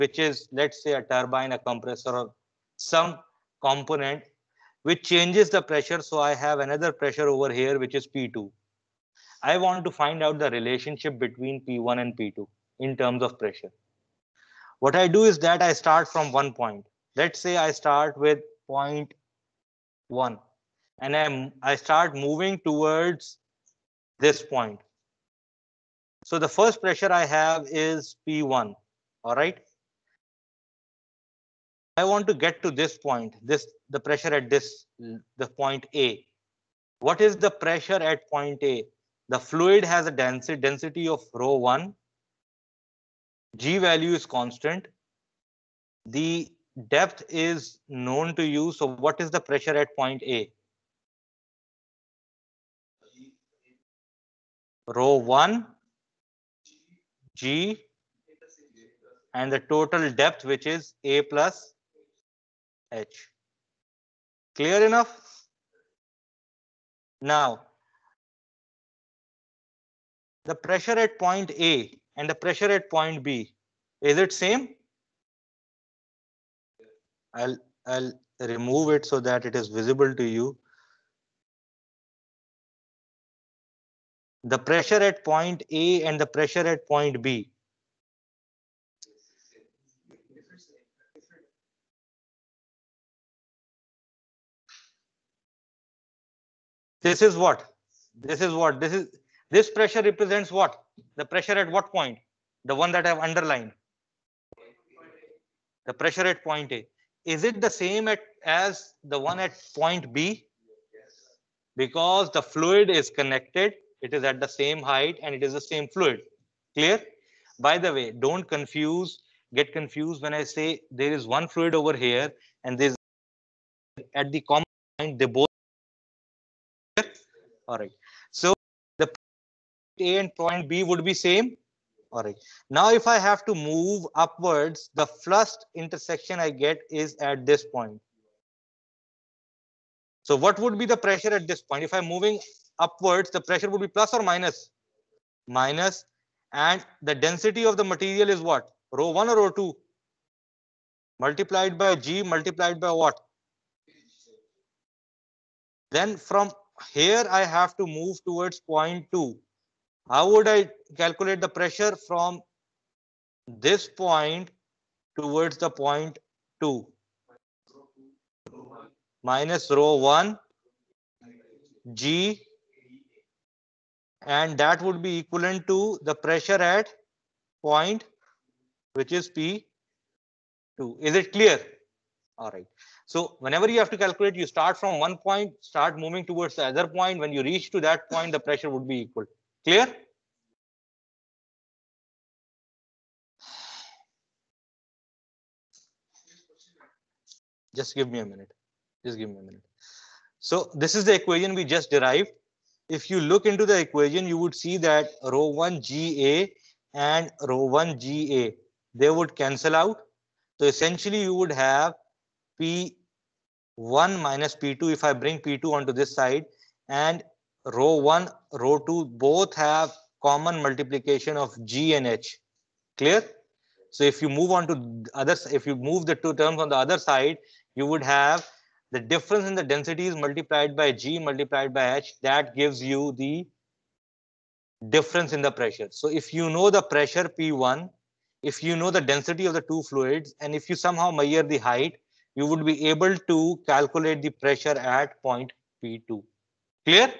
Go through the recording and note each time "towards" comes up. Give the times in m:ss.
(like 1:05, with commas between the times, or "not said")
0:22, 2:38, 2:45, 3:06.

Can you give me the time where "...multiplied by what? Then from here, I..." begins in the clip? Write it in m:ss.
2:32.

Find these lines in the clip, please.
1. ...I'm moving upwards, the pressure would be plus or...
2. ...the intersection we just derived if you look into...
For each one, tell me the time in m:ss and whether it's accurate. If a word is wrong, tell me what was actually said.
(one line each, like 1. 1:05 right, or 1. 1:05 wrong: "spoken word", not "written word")
1. 2:21 right
2. 3:21 wrong: "equation", not "intersection".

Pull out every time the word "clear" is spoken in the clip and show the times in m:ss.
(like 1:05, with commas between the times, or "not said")
1:04, 1:56, 3:01, 3:09, 3:42.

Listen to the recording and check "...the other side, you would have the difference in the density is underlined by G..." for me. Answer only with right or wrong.
wrong.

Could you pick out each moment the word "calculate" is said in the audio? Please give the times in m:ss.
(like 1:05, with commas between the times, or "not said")
2:40, 3:03, 4:03.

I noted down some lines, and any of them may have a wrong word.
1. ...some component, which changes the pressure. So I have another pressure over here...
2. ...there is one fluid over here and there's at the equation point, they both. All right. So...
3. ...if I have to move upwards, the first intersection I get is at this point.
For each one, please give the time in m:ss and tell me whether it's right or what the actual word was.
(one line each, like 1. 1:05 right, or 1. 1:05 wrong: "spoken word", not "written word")
1. 0:02 right
2. 2:00 wrong: "common", not "equation"
3. 2:12 right.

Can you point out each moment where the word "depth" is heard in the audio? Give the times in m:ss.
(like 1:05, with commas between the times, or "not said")
0:46, 1:00.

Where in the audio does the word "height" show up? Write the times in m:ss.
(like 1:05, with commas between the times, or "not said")
1:54, 4:01.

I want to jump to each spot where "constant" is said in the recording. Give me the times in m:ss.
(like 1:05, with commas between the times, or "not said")
0:44.